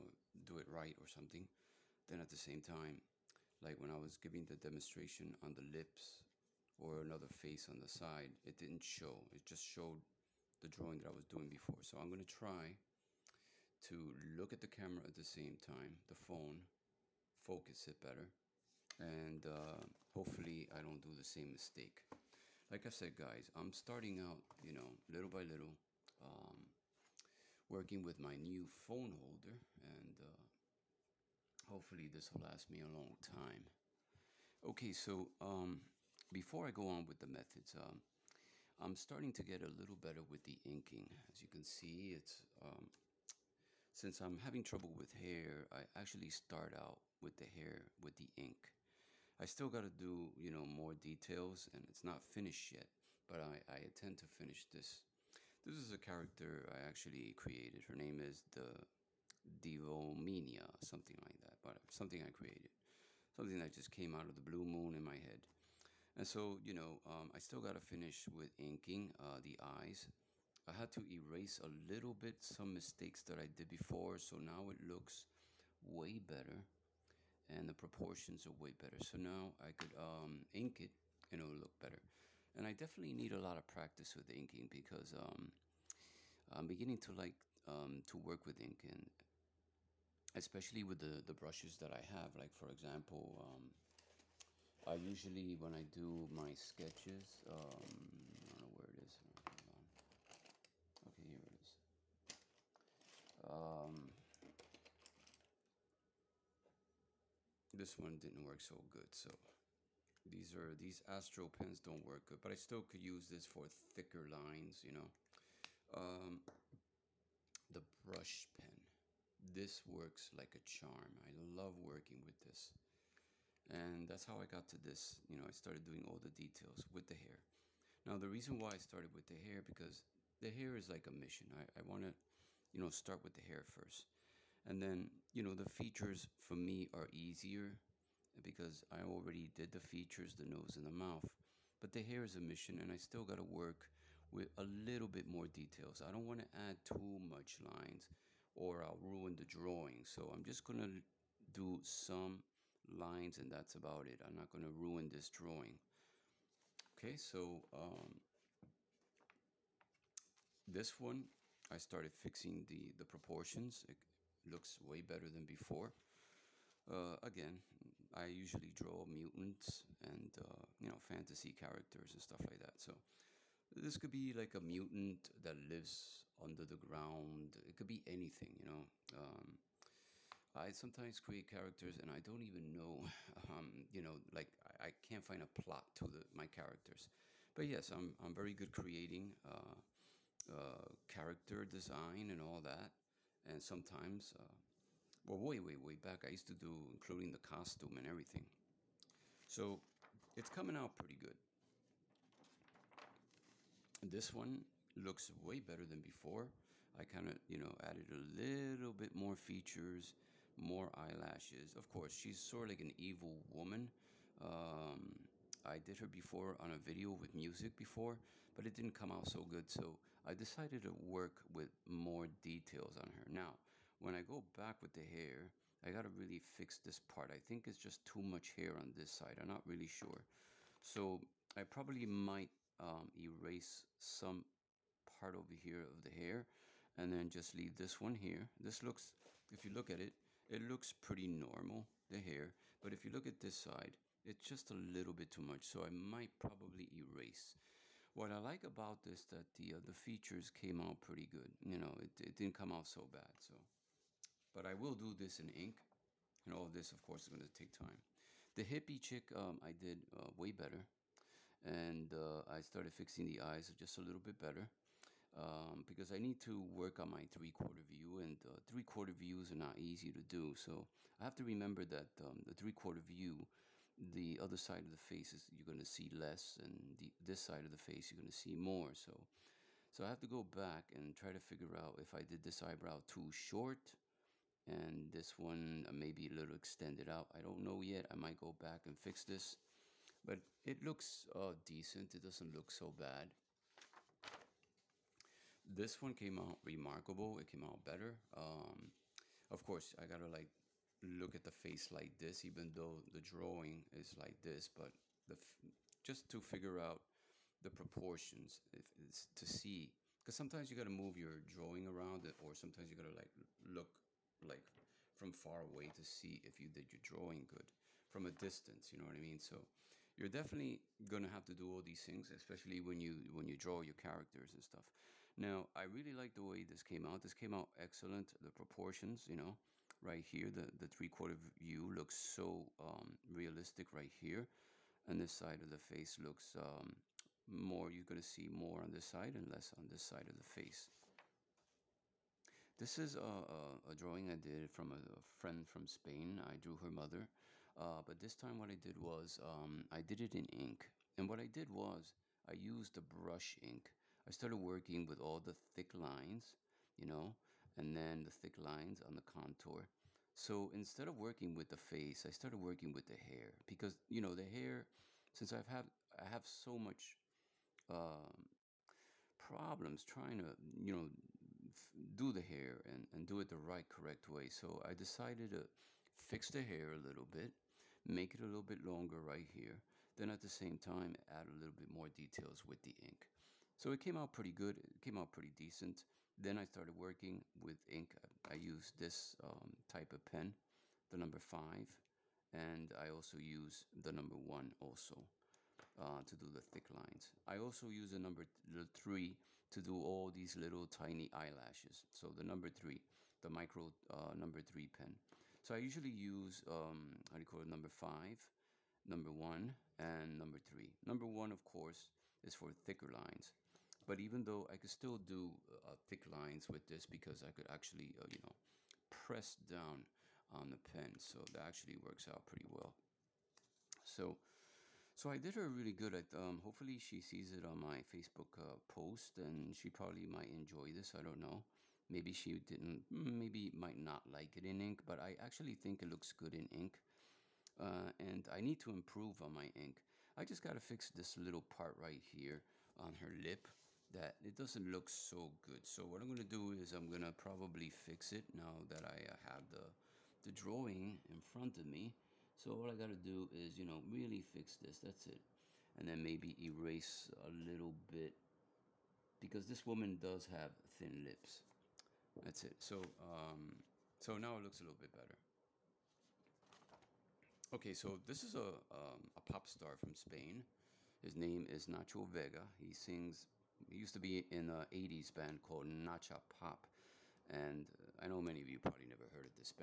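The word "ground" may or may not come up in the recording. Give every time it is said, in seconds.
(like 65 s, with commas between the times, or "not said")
176 s.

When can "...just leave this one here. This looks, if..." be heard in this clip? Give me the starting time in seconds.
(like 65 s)
237 s.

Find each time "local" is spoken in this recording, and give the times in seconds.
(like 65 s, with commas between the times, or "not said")
not said.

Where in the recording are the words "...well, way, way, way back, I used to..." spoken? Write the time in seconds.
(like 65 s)
195 s.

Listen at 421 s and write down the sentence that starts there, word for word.
So that actually works out pretty well.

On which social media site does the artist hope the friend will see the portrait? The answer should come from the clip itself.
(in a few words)
Facebook.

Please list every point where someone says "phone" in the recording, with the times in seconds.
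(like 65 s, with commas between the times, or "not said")
16 s, 28 s.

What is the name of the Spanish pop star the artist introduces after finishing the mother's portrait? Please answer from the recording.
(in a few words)
Nacho Vega.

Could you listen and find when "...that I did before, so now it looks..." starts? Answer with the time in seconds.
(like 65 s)
73 s.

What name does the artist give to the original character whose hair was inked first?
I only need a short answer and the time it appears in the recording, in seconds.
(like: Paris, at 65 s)
Devomania, at 59 s.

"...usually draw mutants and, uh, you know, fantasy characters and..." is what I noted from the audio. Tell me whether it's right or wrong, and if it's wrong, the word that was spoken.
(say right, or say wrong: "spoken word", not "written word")
right.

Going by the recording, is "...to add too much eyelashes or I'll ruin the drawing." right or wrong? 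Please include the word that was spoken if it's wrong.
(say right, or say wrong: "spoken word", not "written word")
wrong: "lines", not "eyelashes".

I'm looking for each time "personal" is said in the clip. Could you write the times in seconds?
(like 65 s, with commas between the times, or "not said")
not said.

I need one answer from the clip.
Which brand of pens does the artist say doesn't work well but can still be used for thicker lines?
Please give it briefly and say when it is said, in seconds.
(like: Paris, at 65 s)
Astro, at 111 s.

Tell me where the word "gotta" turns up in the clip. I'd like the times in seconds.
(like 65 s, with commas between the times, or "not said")
225 s, 300 s.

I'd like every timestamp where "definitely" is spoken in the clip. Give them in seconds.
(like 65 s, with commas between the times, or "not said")
82 s, 320 s.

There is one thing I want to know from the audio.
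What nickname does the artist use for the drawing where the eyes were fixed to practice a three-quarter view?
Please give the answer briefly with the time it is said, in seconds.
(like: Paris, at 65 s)
The hippie chick, at 258 s.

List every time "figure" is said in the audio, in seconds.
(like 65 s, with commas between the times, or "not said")
281 s, 306 s.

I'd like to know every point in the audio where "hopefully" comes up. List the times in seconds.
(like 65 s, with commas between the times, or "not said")
20 s, 31 s, 426 s.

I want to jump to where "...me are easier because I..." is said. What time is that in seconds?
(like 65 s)
136 s.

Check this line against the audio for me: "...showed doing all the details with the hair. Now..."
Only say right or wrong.
wrong.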